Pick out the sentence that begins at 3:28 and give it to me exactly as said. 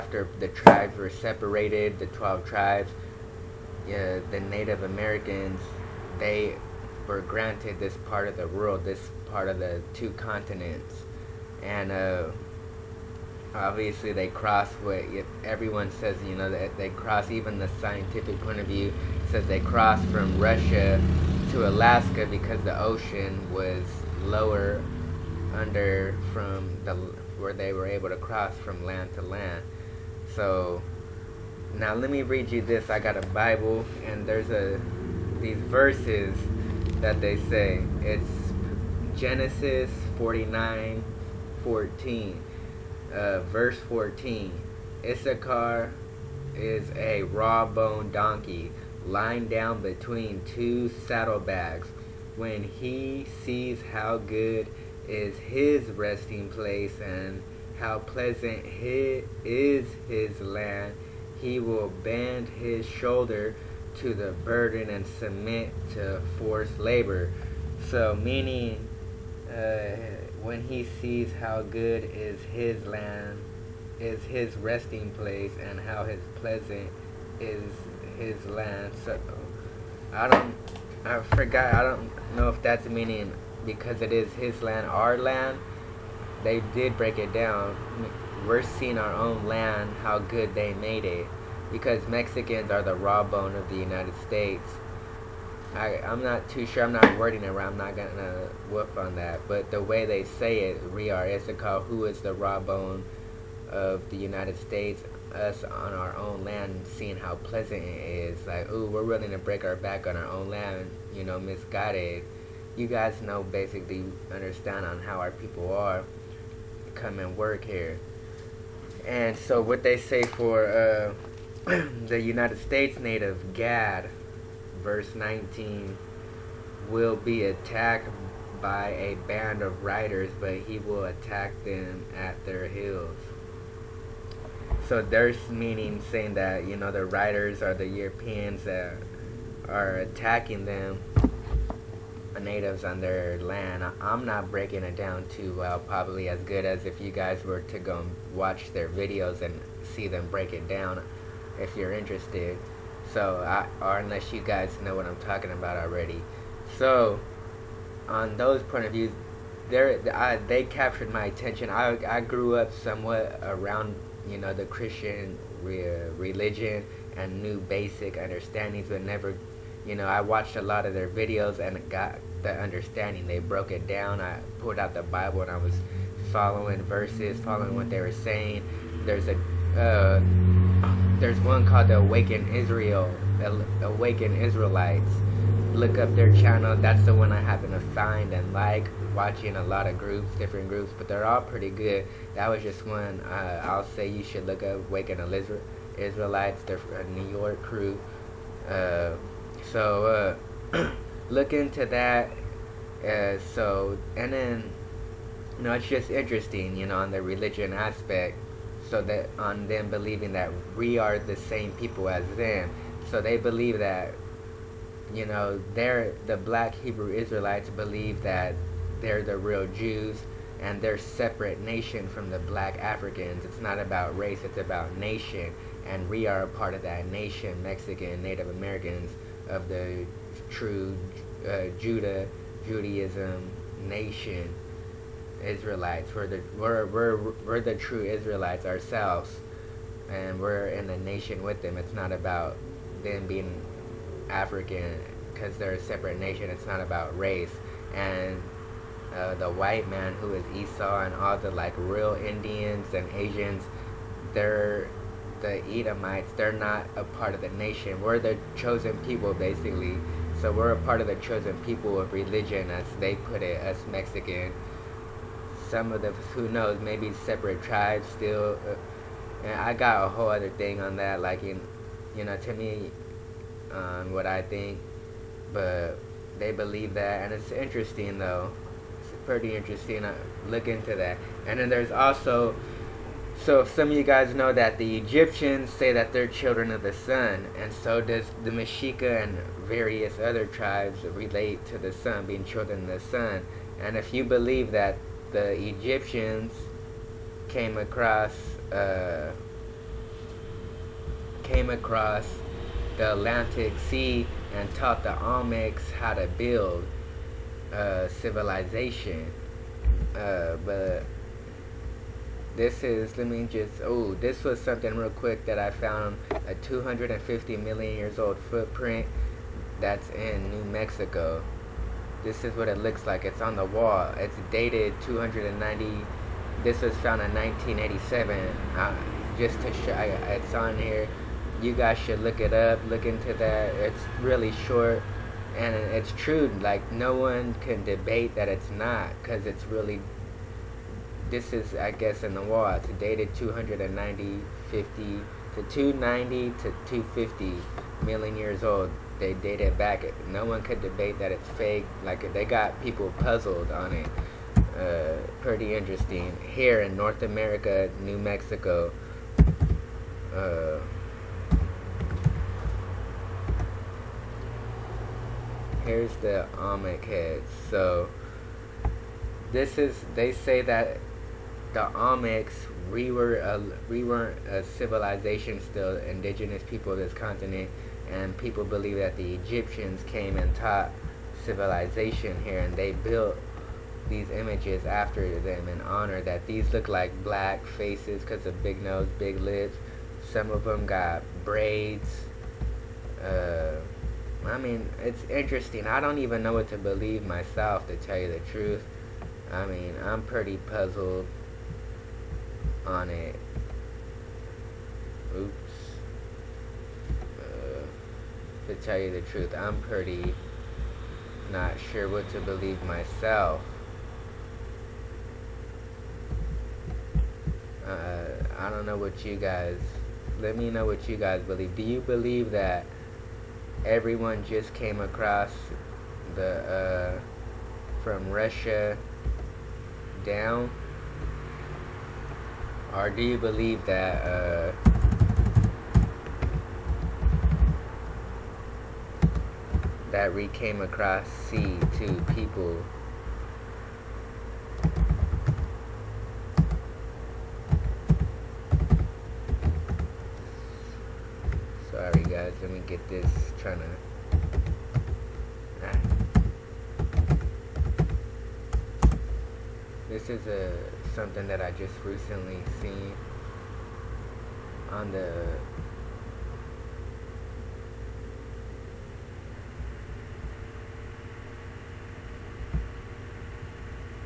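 So that on them believing that we are the same people as them.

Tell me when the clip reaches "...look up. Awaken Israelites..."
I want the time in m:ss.
3:14.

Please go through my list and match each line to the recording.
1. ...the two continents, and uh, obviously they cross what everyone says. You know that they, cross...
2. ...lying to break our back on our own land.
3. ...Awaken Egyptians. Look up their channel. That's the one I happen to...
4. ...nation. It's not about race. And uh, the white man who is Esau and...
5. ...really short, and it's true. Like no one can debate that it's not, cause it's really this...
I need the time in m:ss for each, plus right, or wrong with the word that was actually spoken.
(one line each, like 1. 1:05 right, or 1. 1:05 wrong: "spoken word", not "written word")
1. 0:09 right
2. 1:49 wrong: "willing", not "lying"
3. 3:03 wrong: "Israelites", not "Egyptians"
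4. 4:06 right
5. 5:34 right.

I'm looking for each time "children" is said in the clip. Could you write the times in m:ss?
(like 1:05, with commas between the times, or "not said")
4:46, 4:52.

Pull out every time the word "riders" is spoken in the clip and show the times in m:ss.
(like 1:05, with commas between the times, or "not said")
2:09, 2:17.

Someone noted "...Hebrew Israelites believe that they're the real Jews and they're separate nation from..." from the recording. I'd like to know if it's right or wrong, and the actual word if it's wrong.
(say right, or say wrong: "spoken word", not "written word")
right.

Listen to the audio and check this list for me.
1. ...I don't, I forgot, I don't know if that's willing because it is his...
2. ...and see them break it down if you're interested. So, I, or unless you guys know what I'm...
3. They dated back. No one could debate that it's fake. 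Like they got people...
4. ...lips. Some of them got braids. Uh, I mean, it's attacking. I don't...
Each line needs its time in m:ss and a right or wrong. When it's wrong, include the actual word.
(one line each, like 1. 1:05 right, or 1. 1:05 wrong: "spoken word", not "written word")
1. 1:20 wrong: "meaning", not "willing"
2. 2:29 right
3. 5:49 right
4. 6:29 wrong: "interesting", not "attacking".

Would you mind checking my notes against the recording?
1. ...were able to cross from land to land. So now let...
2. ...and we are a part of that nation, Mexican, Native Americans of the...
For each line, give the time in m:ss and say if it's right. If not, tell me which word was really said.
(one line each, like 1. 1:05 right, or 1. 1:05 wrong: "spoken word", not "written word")
1. 0:27 right
2. 3:45 right.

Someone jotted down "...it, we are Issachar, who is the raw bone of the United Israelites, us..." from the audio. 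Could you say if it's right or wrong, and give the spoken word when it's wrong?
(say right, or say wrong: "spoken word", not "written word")
wrong: "States", not "Israelites".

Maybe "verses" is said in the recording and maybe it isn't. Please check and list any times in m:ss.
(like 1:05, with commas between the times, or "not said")
0:35, 0:43, 2:04, 2:56.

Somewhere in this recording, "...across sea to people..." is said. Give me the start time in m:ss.
7:20.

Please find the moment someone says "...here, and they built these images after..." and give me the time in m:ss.
6:22.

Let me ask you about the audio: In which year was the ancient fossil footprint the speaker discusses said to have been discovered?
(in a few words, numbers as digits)
1987.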